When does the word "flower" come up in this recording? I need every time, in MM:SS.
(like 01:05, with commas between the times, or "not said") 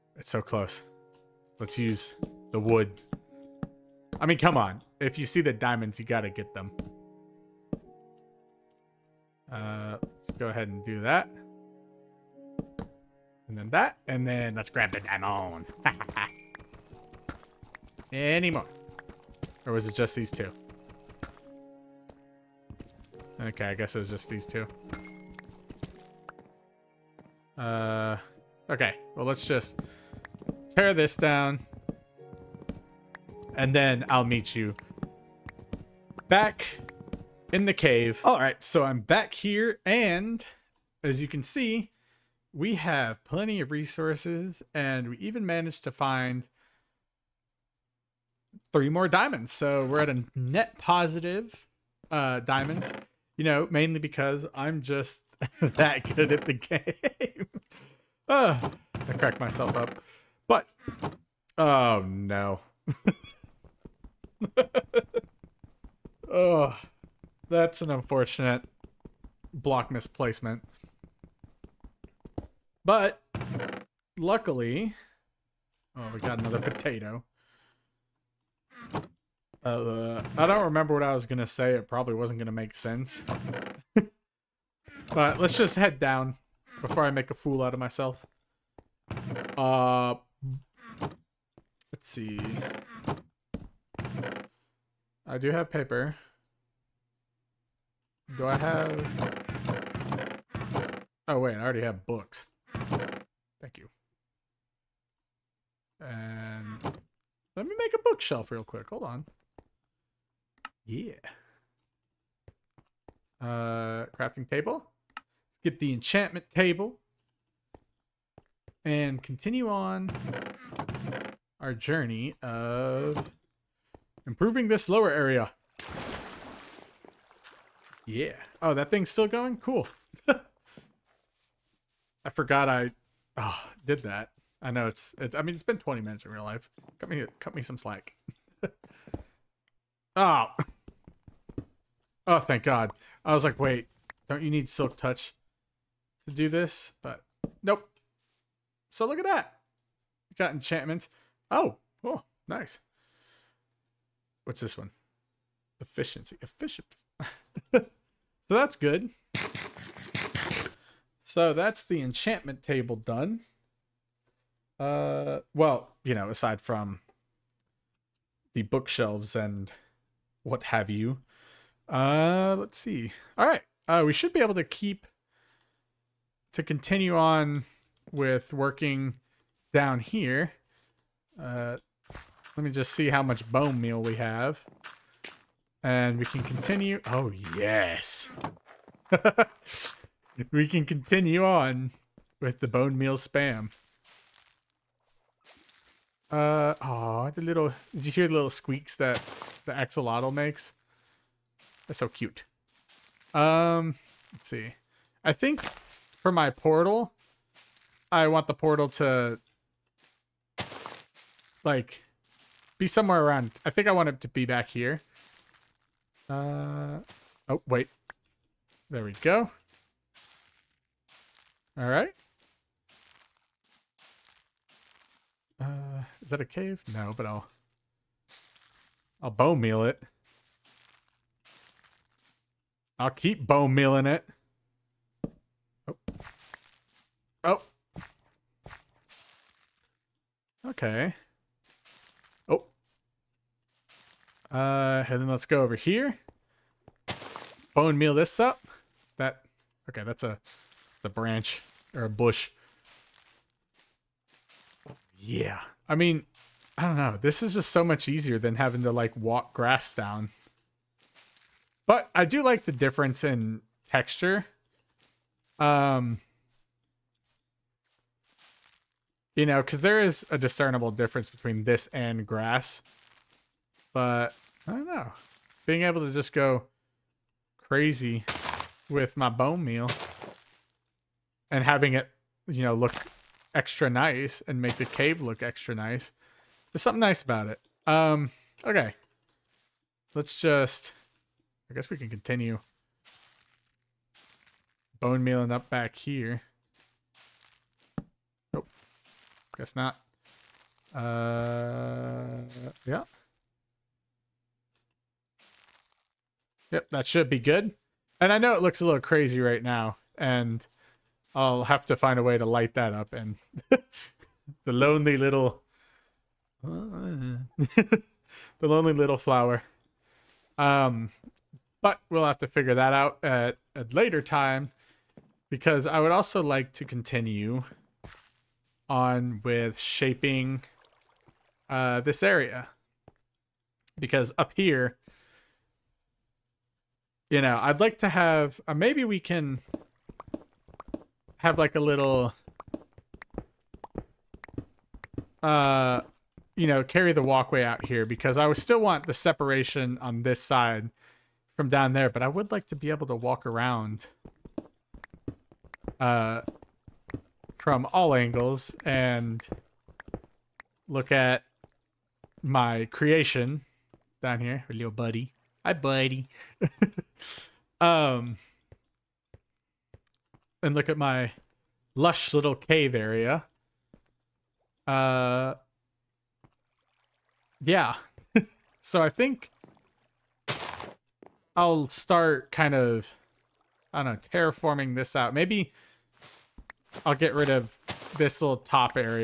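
05:19.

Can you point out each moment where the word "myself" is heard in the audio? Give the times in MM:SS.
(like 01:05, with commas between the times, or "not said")
00:59, 01:27.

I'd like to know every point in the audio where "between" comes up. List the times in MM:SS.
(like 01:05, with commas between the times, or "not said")
04:31.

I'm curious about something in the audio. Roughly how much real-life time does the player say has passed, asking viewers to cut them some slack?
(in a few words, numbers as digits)
20 minutes.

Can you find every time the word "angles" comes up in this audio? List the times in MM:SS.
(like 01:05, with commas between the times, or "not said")
05:58.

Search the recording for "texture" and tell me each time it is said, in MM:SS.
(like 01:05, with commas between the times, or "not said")
04:23.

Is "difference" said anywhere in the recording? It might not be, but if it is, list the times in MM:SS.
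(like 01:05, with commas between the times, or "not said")
04:22, 04:30.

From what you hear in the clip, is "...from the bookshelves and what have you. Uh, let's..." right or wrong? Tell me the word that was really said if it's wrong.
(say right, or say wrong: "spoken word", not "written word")
right.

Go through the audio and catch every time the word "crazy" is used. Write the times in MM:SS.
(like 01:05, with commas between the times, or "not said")
04:37, 05:09.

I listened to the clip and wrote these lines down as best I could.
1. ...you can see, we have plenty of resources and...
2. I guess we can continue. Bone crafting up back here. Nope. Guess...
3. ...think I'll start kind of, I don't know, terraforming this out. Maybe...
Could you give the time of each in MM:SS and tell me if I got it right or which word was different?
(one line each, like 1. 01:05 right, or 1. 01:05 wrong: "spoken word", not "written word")
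1. 00:41 right
2. 04:51 wrong: "mealing", not "crafting"
3. 06:19 right.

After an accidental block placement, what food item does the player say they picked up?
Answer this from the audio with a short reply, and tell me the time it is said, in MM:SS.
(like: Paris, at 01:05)
potato, at 01:16.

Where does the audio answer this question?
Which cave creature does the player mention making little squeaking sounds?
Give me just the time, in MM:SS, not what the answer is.
03:19.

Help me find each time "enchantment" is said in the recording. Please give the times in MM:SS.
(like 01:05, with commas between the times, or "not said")
01:55, 02:30, 02:42.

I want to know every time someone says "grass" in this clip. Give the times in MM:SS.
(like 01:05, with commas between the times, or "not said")
04:19, 04:32.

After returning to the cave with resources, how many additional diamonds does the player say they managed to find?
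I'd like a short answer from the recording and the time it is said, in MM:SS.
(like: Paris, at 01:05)
3, at 00:48.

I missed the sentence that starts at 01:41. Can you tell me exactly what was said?
Oh, wait, I already have books.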